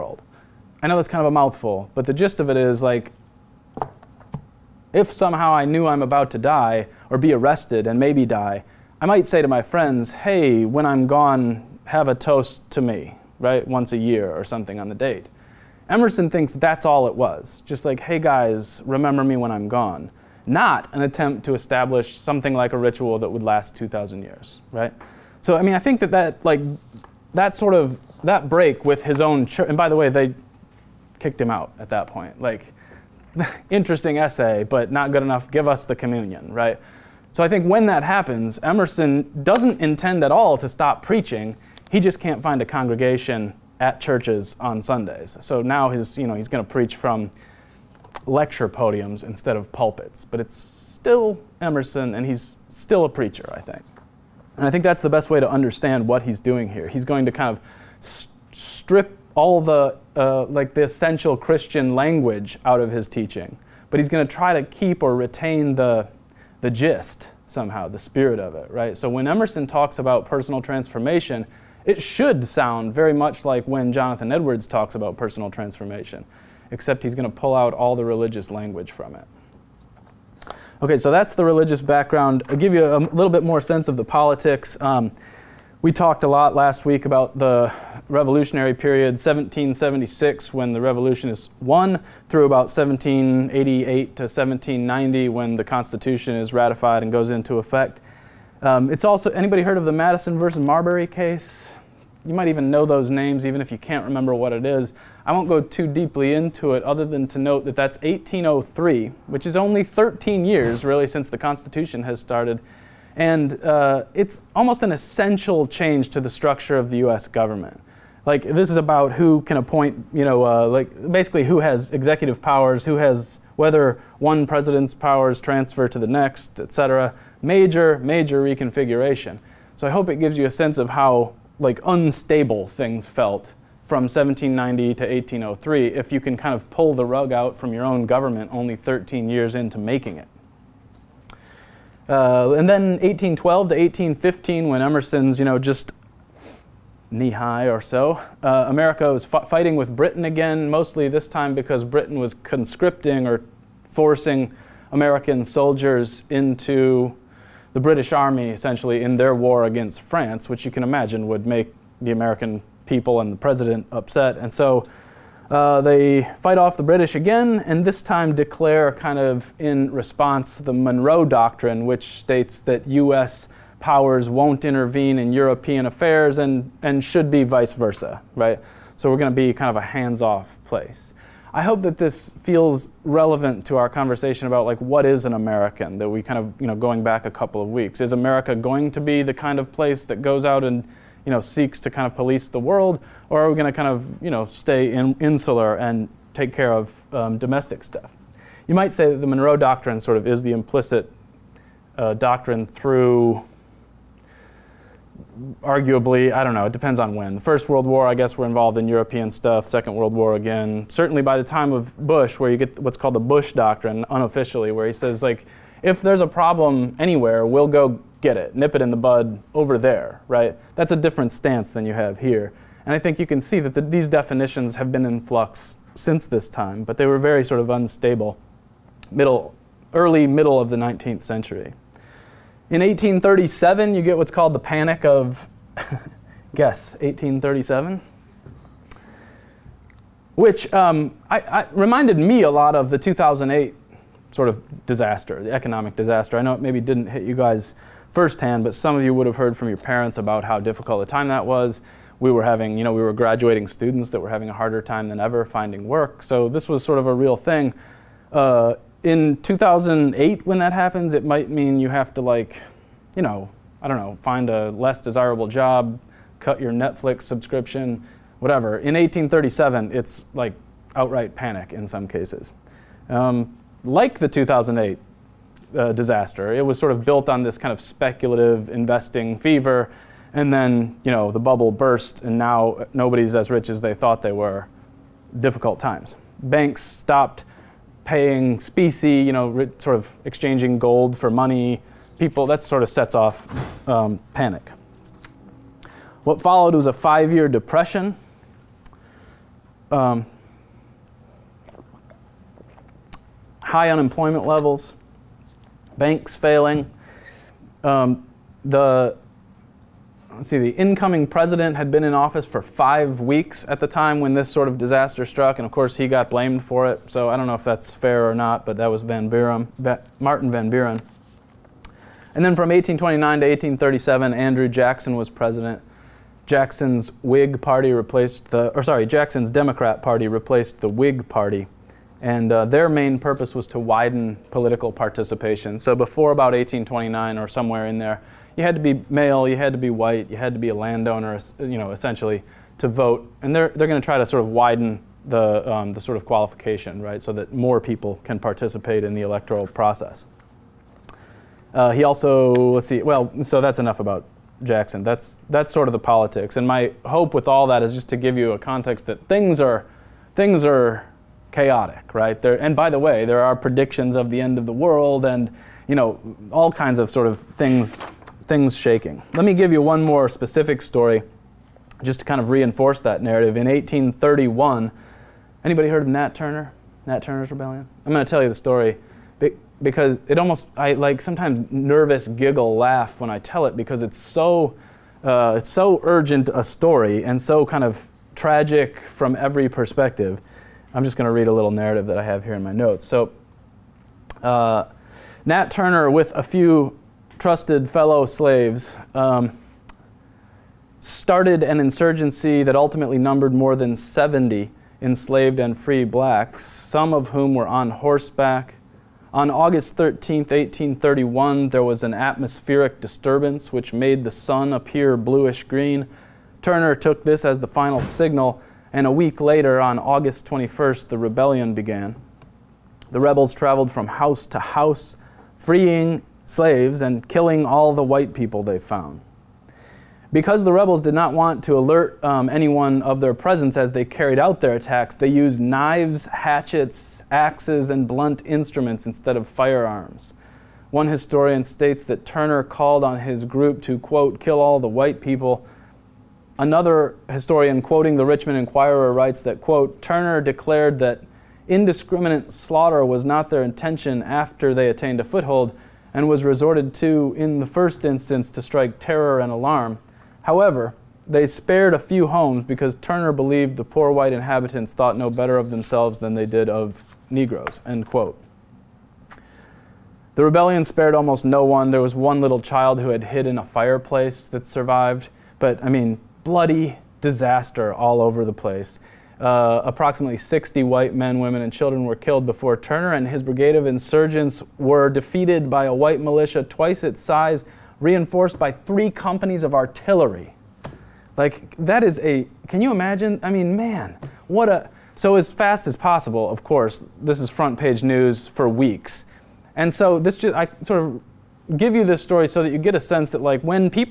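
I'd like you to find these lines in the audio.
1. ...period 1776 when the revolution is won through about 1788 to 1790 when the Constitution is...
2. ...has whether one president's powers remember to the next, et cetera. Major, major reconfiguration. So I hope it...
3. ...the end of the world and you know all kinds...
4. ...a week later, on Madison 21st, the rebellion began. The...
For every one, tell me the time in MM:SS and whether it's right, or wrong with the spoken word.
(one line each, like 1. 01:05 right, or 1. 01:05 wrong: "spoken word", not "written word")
1. 01:28 right
2. 02:02 wrong: "transfer", not "remember"
3. 06:04 right
4. 06:59 wrong: "August", not "Madison".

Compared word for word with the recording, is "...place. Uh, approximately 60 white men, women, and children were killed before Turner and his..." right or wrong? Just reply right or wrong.
right.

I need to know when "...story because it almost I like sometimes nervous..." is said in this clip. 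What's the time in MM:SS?
06:18.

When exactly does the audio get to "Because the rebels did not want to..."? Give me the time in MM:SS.
07:10.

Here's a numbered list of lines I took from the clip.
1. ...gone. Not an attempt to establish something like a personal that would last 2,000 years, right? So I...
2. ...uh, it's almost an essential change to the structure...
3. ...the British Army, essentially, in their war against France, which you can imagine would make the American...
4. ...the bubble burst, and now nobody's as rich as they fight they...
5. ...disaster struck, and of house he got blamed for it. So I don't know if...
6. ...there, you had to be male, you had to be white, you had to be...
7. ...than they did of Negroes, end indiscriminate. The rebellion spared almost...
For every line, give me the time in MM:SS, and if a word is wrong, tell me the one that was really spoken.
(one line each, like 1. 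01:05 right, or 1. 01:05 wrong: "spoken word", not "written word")
1. 00:19 wrong: "ritual", not "personal"
2. 01:53 right
3. 02:37 right
4. 04:41 wrong: "thought", not "fight"
5. 05:14 wrong: "course", not "house"
6. 05:37 right
7. 07:46 wrong: "quote", not "indiscriminate".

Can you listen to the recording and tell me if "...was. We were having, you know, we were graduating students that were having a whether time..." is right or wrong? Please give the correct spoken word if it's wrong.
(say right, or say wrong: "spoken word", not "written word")
wrong: "harder", not "whether".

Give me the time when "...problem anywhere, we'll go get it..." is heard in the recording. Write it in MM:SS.
03:36.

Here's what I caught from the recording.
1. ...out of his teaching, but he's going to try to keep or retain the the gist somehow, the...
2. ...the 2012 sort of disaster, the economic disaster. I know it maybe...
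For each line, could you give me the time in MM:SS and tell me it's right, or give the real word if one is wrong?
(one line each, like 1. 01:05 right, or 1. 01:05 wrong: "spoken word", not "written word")
1. 01:02 right
2. 04:02 wrong: "2008", not "2012".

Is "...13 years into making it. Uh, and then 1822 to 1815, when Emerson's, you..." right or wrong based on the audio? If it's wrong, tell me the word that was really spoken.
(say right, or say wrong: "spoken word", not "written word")
wrong: "1812", not "1822".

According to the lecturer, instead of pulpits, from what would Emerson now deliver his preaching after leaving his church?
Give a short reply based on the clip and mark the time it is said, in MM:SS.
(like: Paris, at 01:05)
lecture podiums, at 00:48.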